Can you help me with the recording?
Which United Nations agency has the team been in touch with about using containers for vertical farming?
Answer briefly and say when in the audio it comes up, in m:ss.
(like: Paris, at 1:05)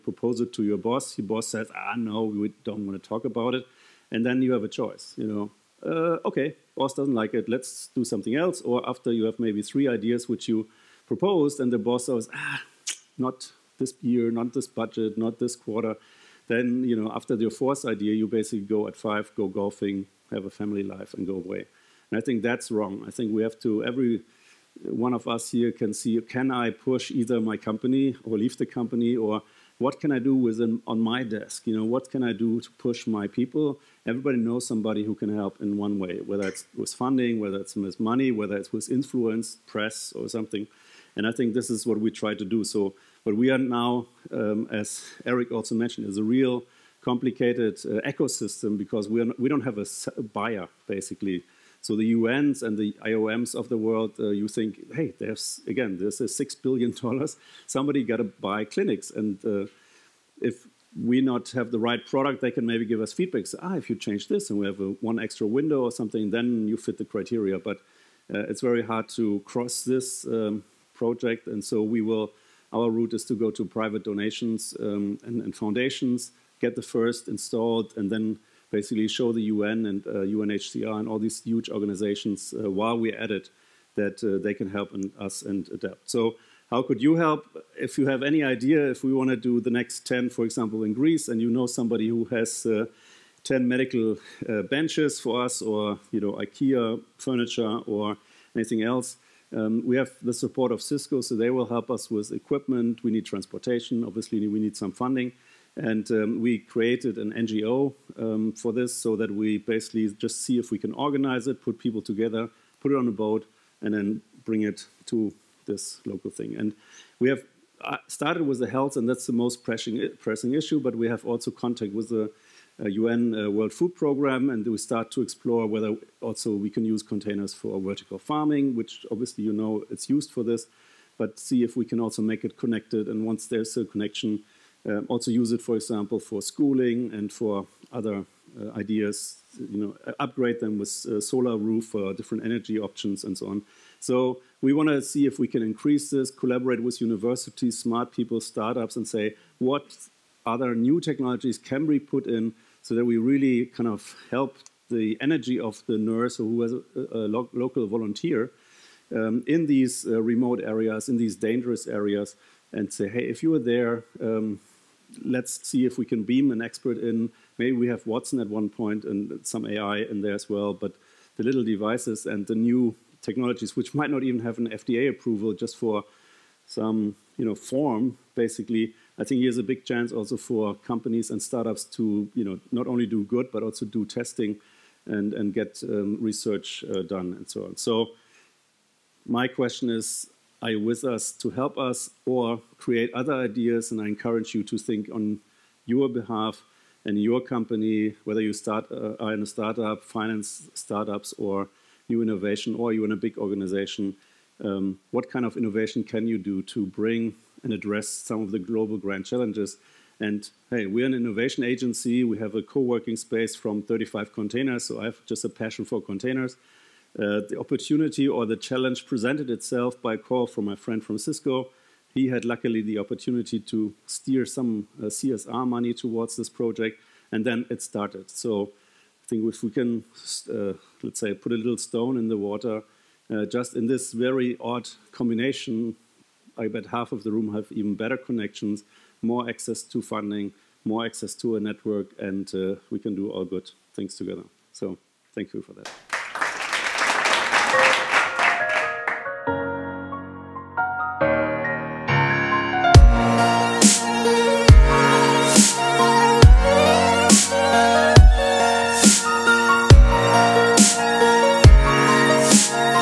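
World Food Program, at 2:03.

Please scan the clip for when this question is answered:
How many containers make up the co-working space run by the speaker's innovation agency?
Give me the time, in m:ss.
3:33.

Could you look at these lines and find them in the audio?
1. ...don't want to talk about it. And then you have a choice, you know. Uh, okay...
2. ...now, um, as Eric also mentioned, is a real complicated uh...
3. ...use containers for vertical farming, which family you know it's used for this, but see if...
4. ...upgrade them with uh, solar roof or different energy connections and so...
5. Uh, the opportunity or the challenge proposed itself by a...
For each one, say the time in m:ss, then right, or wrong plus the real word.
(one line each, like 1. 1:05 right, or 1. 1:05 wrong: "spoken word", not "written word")
1. 0:02 right
2. 0:43 right
3. 2:06 wrong: "obviously", not "family"
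4. 2:20 wrong: "options", not "connections"
5. 3:37 wrong: "presented", not "proposed".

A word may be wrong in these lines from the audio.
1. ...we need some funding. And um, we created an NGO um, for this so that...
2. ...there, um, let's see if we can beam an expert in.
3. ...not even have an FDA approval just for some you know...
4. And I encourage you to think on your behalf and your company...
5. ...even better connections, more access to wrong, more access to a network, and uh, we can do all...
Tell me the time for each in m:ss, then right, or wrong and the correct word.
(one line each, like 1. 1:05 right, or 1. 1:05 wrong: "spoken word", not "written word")
1. 1:44 right
2. 2:43 right
3. 2:54 right
4. 3:13 right
5. 3:57 wrong: "funding", not "wrong".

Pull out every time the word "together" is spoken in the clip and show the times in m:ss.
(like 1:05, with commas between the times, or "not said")
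1:52, 4:04.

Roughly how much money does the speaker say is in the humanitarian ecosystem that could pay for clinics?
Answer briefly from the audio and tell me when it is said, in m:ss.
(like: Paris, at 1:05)
$6 billion, at 0:56.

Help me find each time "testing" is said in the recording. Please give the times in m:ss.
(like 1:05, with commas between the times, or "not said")
3:04.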